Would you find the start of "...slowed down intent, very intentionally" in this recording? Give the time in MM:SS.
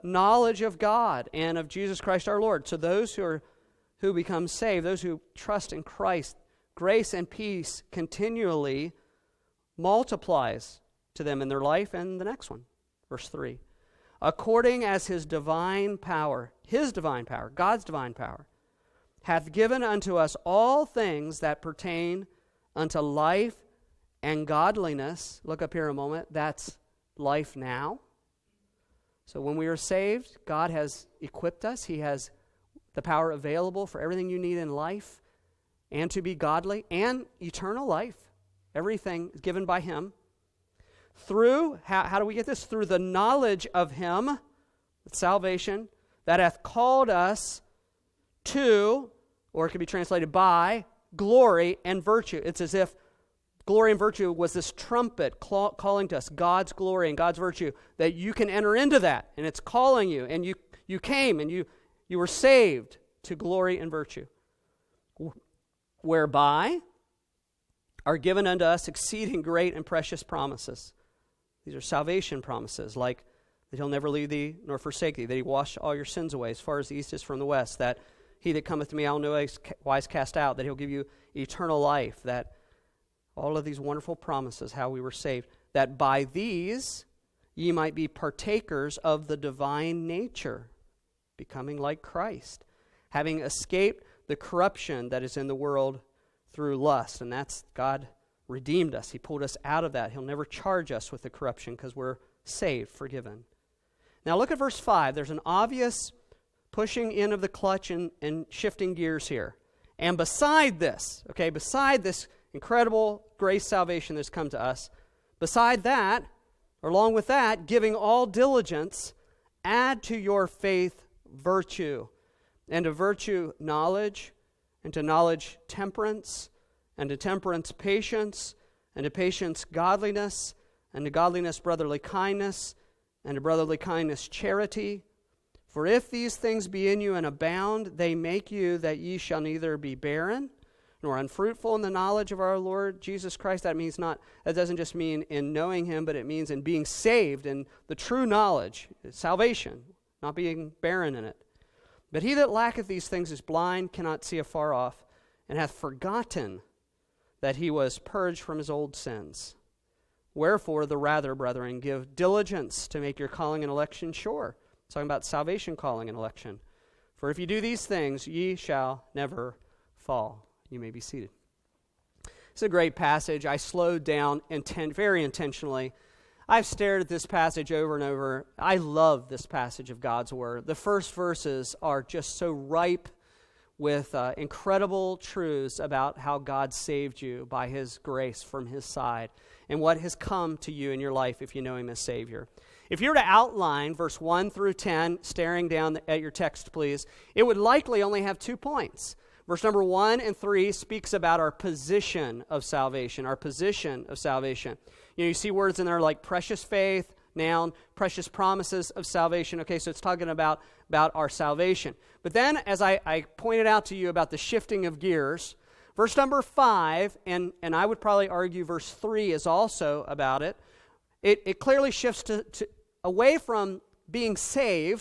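02:53.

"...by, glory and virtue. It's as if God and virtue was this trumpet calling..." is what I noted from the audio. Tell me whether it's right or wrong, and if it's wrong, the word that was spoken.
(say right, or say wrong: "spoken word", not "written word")
wrong: "Glory", not "God".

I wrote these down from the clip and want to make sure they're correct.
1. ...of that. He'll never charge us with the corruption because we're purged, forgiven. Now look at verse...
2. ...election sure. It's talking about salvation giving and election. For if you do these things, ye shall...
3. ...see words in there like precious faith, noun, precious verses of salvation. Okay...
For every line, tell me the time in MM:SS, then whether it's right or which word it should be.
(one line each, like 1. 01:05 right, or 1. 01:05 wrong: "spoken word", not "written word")
1. 01:39 wrong: "saved", not "purged"
2. 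02:43 wrong: "calling", not "giving"
3. 03:25 wrong: "promises", not "verses".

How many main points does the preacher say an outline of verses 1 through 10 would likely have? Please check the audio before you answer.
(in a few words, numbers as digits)
2.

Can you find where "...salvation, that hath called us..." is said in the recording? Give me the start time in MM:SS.
00:45.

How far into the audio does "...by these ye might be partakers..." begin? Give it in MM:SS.
01:25.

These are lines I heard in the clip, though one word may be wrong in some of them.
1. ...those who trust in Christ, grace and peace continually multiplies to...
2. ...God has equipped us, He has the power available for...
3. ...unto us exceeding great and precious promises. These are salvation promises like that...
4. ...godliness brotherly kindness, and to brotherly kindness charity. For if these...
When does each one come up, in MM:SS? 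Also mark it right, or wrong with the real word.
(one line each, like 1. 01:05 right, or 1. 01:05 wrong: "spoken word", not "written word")
1. 00:04 right
2. 00:30 right
3. 01:08 right
4. 02:11 right.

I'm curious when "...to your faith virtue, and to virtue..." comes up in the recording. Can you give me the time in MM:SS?
02:00.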